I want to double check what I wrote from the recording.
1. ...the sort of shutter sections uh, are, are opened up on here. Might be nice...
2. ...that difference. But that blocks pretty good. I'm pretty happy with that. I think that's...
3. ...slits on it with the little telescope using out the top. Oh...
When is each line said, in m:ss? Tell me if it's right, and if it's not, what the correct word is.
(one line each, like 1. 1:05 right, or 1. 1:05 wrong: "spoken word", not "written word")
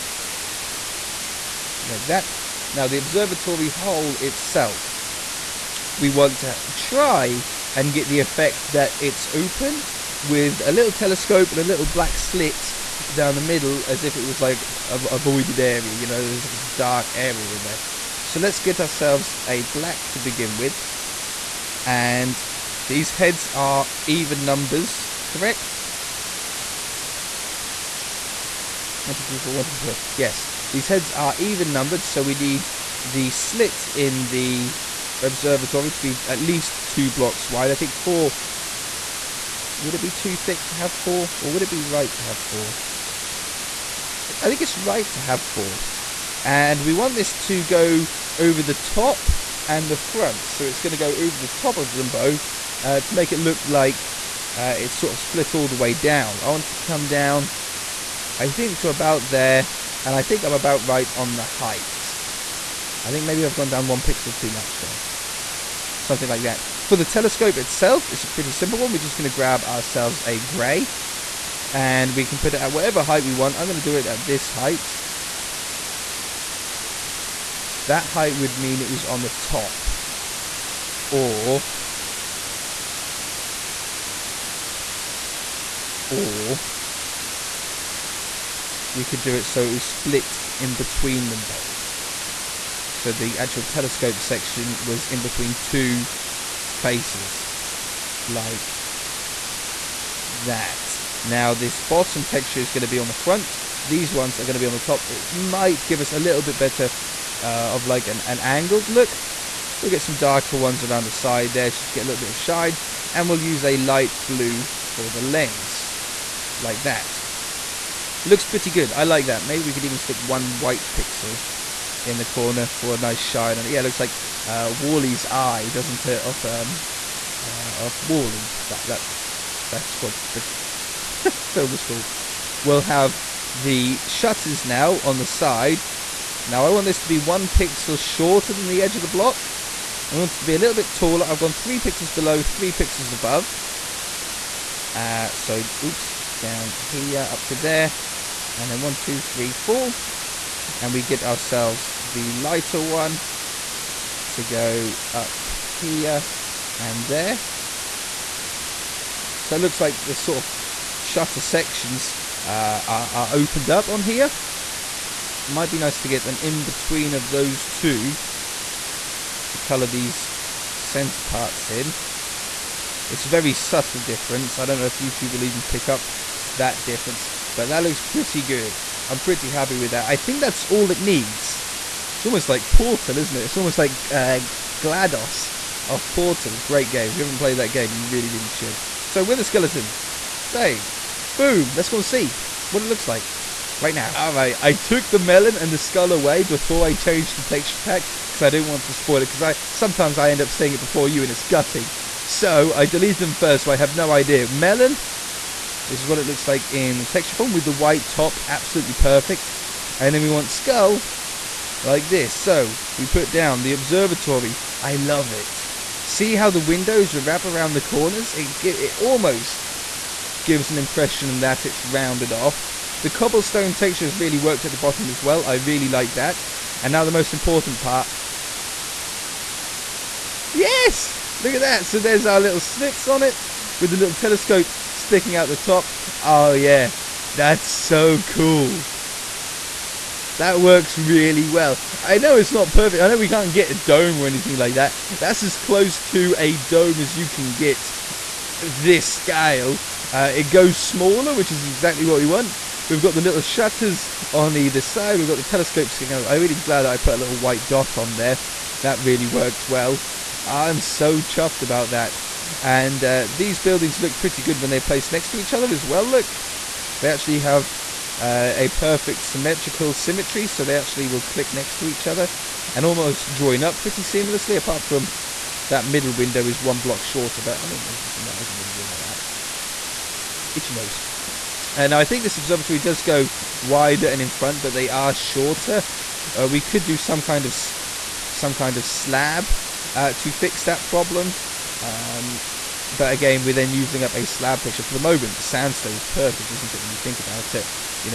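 1. 2:40 right
2. 2:56 wrong: "looks", not "blocks"
3. 3:52 wrong: "sticking", not "using".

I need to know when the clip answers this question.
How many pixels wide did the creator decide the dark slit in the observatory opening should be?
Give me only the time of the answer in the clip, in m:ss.
0:44.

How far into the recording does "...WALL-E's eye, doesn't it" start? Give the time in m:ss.
2:04.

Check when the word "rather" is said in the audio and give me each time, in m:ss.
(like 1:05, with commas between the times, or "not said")
not said.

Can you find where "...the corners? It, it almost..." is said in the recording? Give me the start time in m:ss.
3:37.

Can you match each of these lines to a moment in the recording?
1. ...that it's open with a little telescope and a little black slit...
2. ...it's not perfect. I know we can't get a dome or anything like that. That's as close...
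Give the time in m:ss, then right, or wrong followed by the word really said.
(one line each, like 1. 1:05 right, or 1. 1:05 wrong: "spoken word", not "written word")
1. 0:08 right
2. 4:02 right.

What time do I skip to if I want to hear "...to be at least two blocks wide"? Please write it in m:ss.
0:35.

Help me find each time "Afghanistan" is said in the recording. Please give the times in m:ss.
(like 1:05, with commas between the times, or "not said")
not said.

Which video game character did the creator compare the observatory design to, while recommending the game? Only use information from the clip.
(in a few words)
GLaDOS.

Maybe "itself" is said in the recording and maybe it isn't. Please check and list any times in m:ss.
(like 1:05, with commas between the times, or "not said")
0:04, 1:07.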